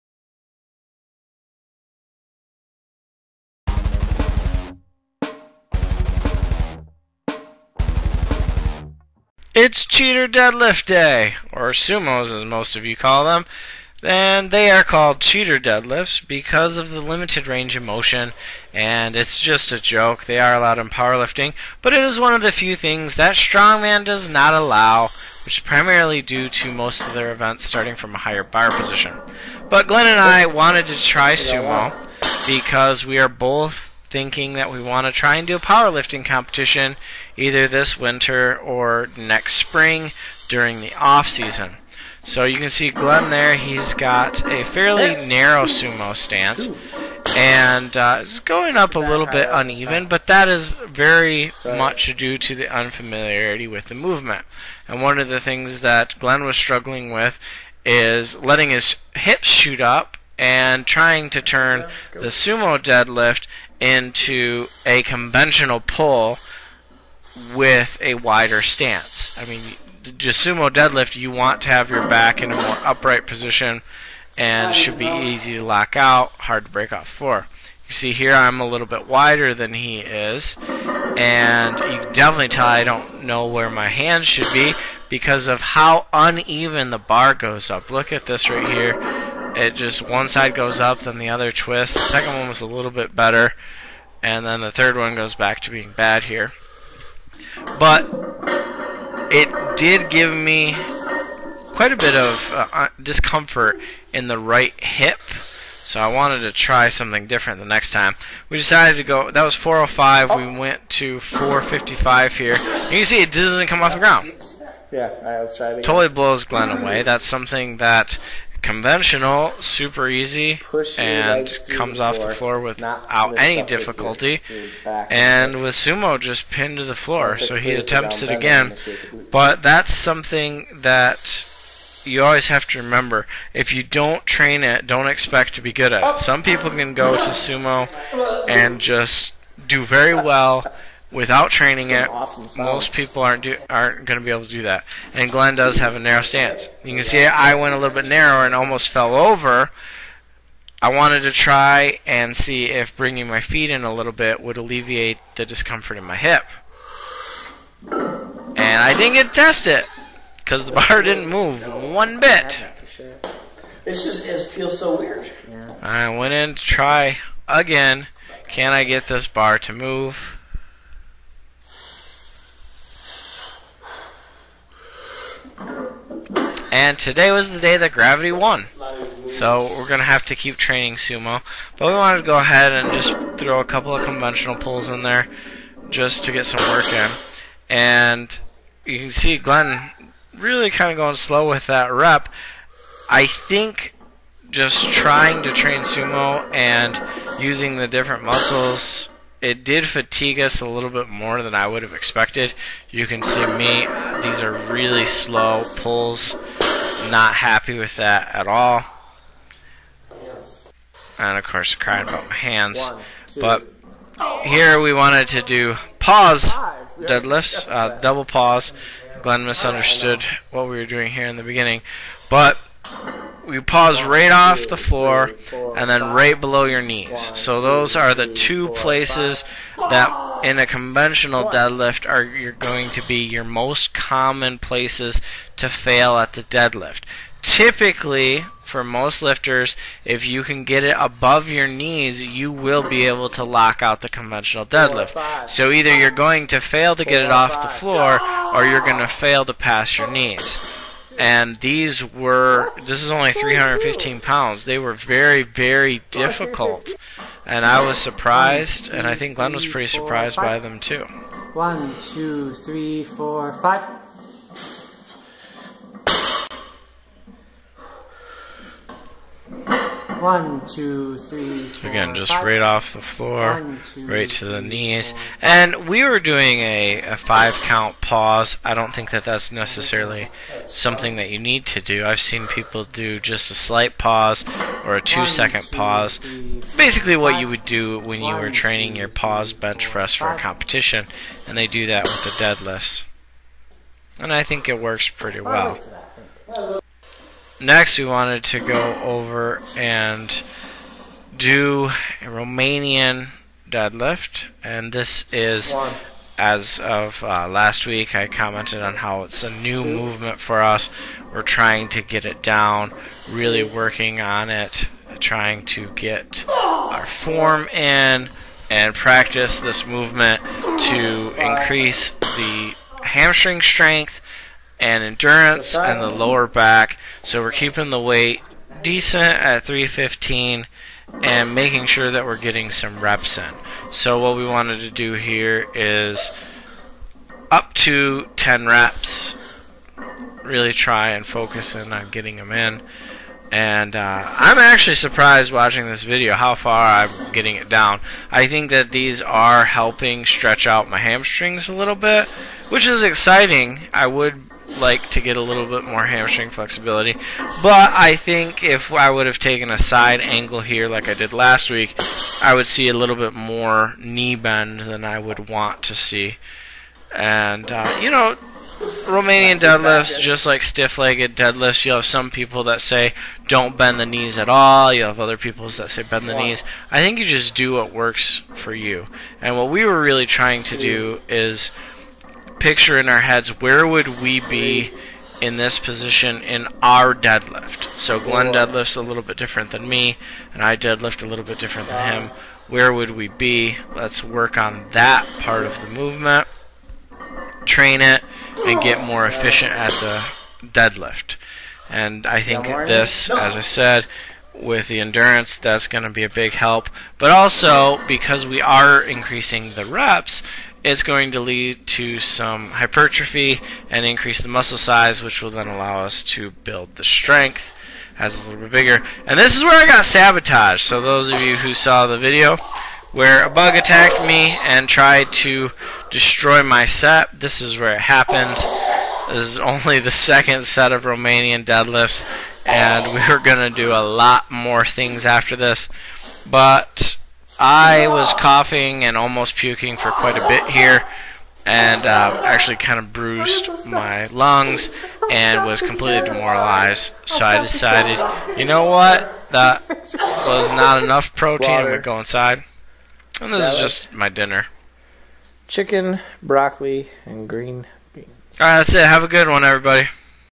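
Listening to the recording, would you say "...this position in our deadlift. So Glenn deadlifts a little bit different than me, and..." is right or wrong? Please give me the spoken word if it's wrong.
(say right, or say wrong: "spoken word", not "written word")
right.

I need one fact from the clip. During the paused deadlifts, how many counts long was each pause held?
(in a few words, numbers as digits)
5.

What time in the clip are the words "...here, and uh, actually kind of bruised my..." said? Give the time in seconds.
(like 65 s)
440 s.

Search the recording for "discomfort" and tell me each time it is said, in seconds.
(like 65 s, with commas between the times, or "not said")
103 s, 155 s.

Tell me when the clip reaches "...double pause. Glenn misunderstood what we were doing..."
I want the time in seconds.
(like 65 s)
217 s.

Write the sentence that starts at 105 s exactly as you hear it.
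So I wanted to try something different the next time.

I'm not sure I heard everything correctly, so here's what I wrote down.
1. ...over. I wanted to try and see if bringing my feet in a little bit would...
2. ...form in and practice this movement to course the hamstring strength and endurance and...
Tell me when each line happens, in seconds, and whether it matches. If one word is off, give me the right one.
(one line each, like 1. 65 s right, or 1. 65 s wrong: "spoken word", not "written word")
1. 149 s right
2. 317 s wrong: "increase", not "course".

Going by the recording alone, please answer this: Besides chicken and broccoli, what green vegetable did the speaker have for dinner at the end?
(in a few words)
green beans.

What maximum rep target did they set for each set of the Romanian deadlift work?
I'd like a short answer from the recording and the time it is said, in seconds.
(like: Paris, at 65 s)
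10, at 338 s.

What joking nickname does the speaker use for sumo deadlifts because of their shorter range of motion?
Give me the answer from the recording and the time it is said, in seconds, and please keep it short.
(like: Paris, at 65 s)
cheater deadlifts, at 9 s.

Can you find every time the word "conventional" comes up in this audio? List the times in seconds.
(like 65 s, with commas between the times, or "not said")
65 s, 118 s, 184 s, 230 s, 244 s.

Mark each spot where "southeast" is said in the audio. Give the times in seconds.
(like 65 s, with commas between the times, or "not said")
not said.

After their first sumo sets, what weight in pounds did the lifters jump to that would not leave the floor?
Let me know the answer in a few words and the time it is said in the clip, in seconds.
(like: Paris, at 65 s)
455, at 111 s.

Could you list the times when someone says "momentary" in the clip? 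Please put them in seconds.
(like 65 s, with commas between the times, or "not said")
not said.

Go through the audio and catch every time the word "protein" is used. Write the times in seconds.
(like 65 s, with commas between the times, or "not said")
451 s.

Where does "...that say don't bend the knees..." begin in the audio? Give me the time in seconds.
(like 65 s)
372 s.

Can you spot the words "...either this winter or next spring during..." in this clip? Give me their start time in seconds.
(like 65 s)
37 s.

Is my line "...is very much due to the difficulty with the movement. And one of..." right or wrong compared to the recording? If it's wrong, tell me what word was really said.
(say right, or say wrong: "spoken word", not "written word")
wrong: "unfamiliarity", not "difficulty".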